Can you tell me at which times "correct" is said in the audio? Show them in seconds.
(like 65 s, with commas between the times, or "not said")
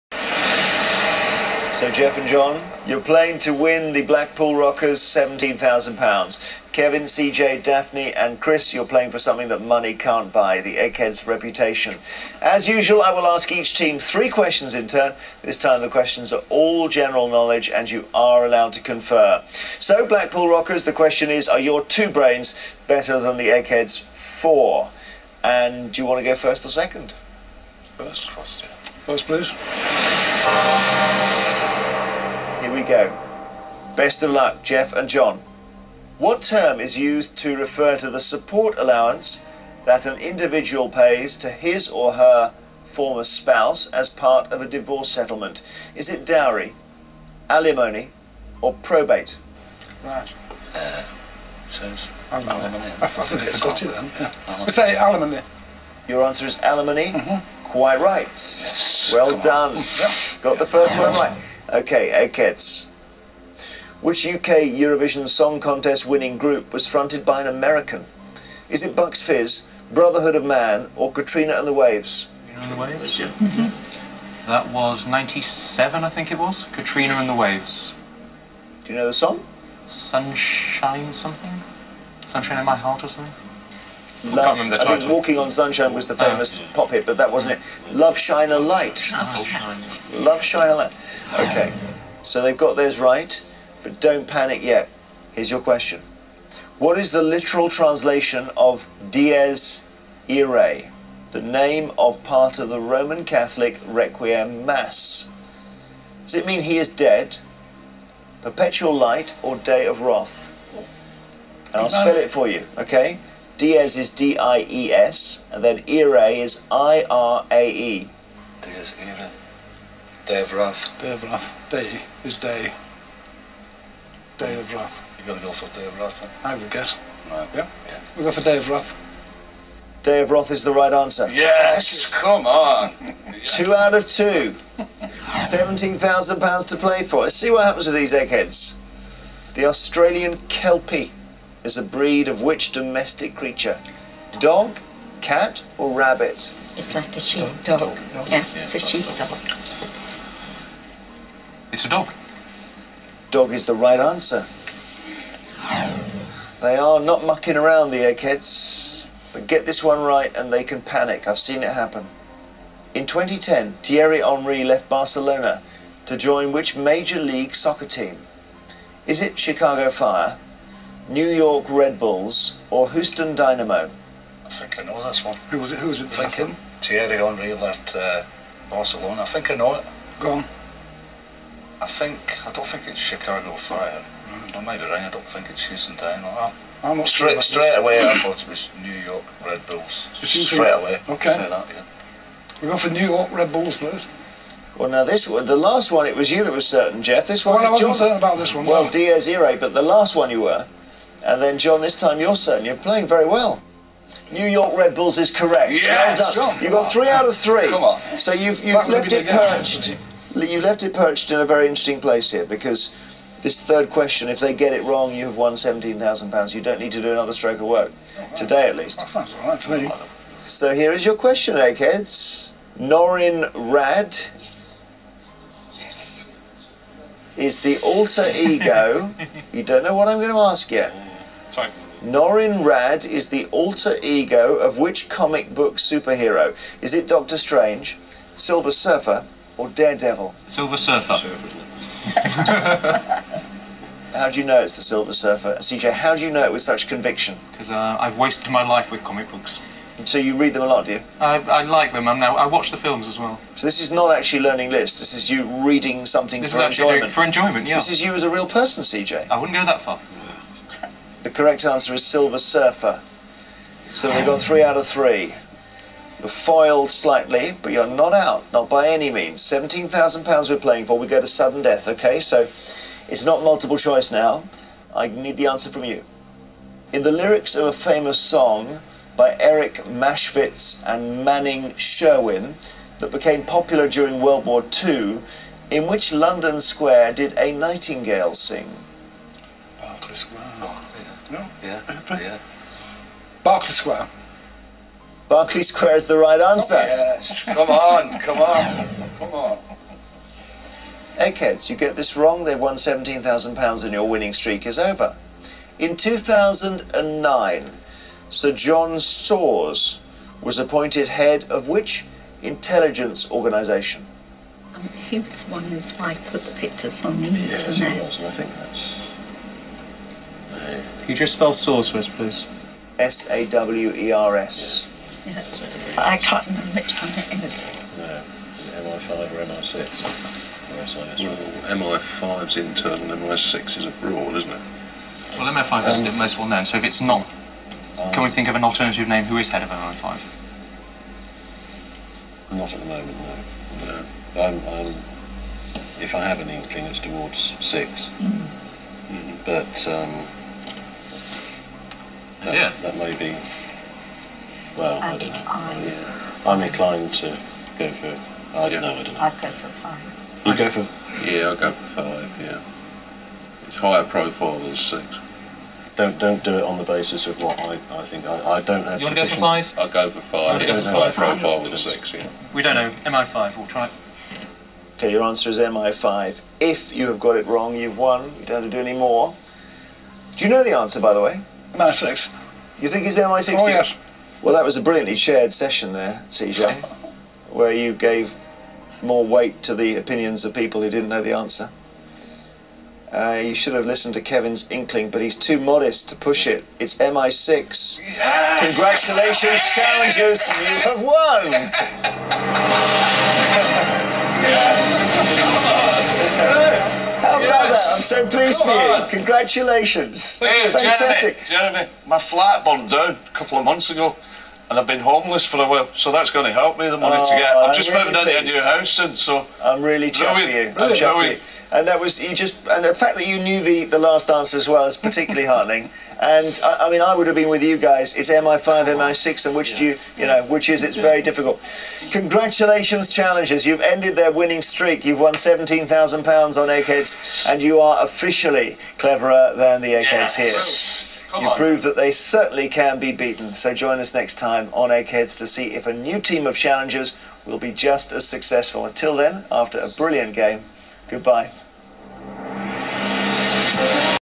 205 s, 261 s.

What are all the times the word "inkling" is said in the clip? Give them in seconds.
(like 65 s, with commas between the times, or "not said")
346 s, 394 s.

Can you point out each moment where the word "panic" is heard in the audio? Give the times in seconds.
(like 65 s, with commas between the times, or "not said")
94 s, 160 s.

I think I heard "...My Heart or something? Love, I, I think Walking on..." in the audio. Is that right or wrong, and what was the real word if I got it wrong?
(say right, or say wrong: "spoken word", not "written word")
right.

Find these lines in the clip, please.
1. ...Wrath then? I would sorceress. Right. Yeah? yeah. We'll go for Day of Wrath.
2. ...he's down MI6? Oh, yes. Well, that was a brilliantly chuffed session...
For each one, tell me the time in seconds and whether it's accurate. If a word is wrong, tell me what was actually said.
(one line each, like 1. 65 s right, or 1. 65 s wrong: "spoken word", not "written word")
1. 125 s wrong: "guess", not "sorceress"
2. 383 s wrong: "shared", not "chuffed".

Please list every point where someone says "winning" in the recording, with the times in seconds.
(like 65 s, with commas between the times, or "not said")
66 s, 304 s, 434 s.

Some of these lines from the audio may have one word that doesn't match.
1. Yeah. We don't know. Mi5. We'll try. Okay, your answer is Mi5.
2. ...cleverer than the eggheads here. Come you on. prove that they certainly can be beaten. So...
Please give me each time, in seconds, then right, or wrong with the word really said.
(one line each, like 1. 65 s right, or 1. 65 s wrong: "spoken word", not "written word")
1. 372 s right
2. 438 s right.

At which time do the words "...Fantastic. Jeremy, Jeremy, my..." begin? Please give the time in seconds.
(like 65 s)
410 s.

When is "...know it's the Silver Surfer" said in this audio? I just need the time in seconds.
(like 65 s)
244 s.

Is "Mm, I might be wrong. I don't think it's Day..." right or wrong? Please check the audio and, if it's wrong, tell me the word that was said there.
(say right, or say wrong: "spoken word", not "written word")
wrong: "Houston", not "Day".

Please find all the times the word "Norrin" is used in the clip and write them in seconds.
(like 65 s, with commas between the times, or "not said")
222 s, 232 s.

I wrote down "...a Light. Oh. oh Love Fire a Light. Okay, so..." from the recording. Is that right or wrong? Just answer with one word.
wrong.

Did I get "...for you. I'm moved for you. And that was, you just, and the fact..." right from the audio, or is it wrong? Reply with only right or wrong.
wrong.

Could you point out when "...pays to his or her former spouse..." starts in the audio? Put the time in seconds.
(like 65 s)
40 s.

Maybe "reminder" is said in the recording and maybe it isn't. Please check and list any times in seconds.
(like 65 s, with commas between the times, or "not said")
not said.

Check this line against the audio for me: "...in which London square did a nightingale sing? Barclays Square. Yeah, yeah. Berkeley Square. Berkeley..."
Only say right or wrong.
right.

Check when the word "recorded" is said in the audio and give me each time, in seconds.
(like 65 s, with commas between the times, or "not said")
not said.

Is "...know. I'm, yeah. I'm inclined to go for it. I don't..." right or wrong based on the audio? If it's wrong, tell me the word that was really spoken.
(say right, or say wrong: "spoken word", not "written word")
right.